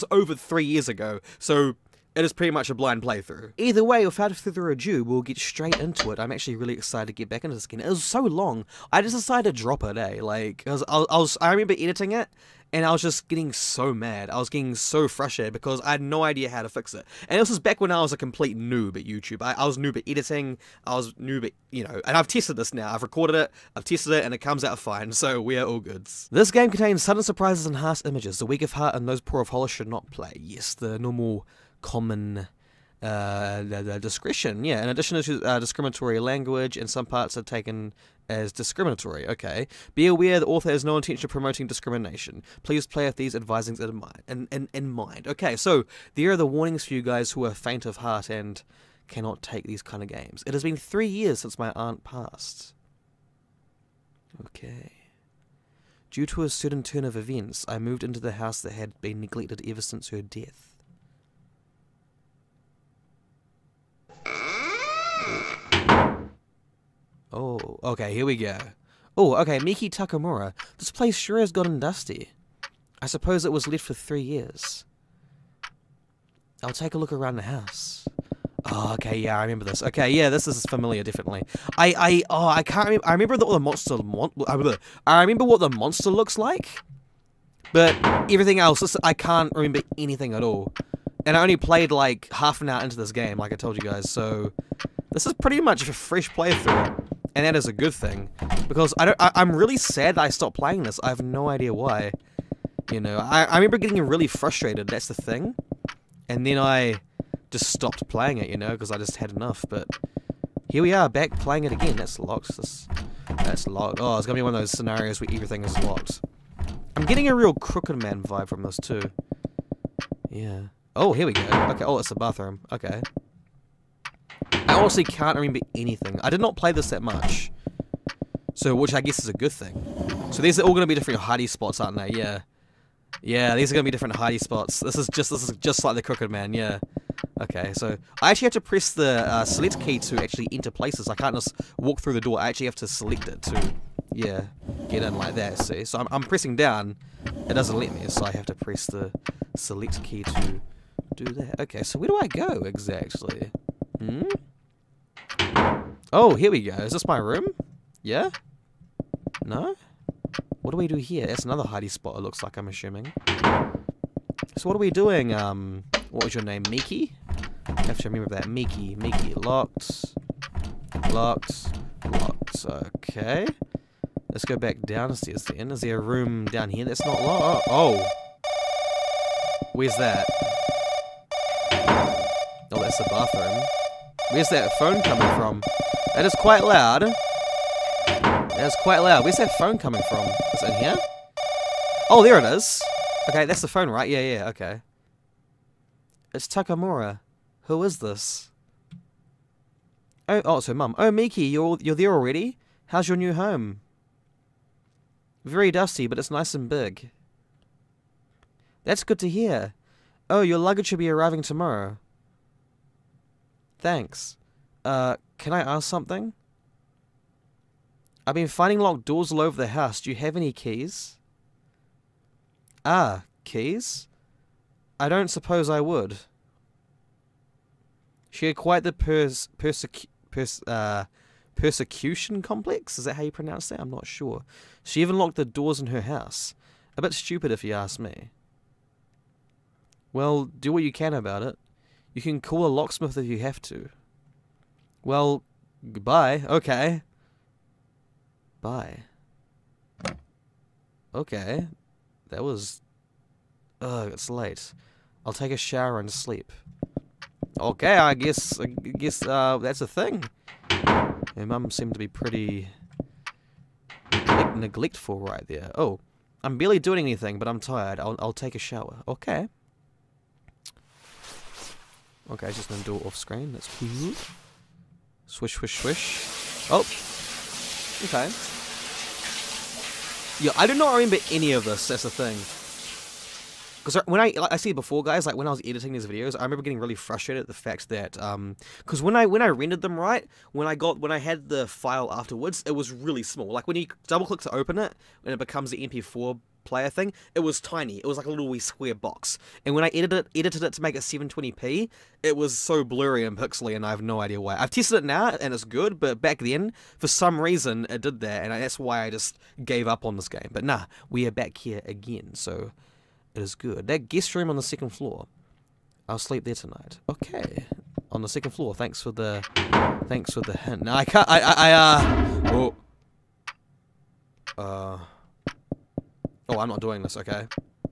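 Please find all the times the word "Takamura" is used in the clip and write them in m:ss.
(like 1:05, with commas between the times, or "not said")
1:09, 3:16.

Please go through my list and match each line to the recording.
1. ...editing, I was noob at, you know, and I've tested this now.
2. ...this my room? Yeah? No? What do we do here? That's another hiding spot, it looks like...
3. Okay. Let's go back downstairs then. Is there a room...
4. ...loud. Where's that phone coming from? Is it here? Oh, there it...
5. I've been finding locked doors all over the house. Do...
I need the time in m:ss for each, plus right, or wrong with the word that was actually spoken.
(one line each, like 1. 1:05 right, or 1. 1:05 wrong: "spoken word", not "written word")
1. 0:20 right
2. 2:36 right
3. 2:52 right
4. 3:08 right
5. 3:38 right.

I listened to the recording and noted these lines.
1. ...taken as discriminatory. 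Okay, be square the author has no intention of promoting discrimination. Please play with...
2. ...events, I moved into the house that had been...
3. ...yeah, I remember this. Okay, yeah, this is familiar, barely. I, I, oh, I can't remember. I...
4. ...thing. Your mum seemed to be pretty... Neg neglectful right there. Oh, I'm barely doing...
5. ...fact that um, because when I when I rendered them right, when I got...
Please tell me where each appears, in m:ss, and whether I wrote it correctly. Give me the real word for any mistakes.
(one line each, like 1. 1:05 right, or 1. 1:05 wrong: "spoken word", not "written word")
1. 0:37 wrong: "aware", not "square"
2. 0:57 right
3. 1:19 wrong: "definitely", not "barely"
4. 4:19 right
5. 4:47 right.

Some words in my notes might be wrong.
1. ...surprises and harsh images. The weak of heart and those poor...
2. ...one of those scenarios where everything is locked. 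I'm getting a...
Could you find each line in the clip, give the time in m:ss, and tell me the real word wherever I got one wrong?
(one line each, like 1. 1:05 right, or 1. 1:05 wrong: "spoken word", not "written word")
1. 0:27 right
2. 1:54 right.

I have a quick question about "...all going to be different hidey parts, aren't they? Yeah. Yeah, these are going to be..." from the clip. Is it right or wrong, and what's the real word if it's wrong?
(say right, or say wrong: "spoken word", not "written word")
wrong: "spots", not "parts".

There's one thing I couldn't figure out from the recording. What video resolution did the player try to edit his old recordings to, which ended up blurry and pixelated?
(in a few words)
720p.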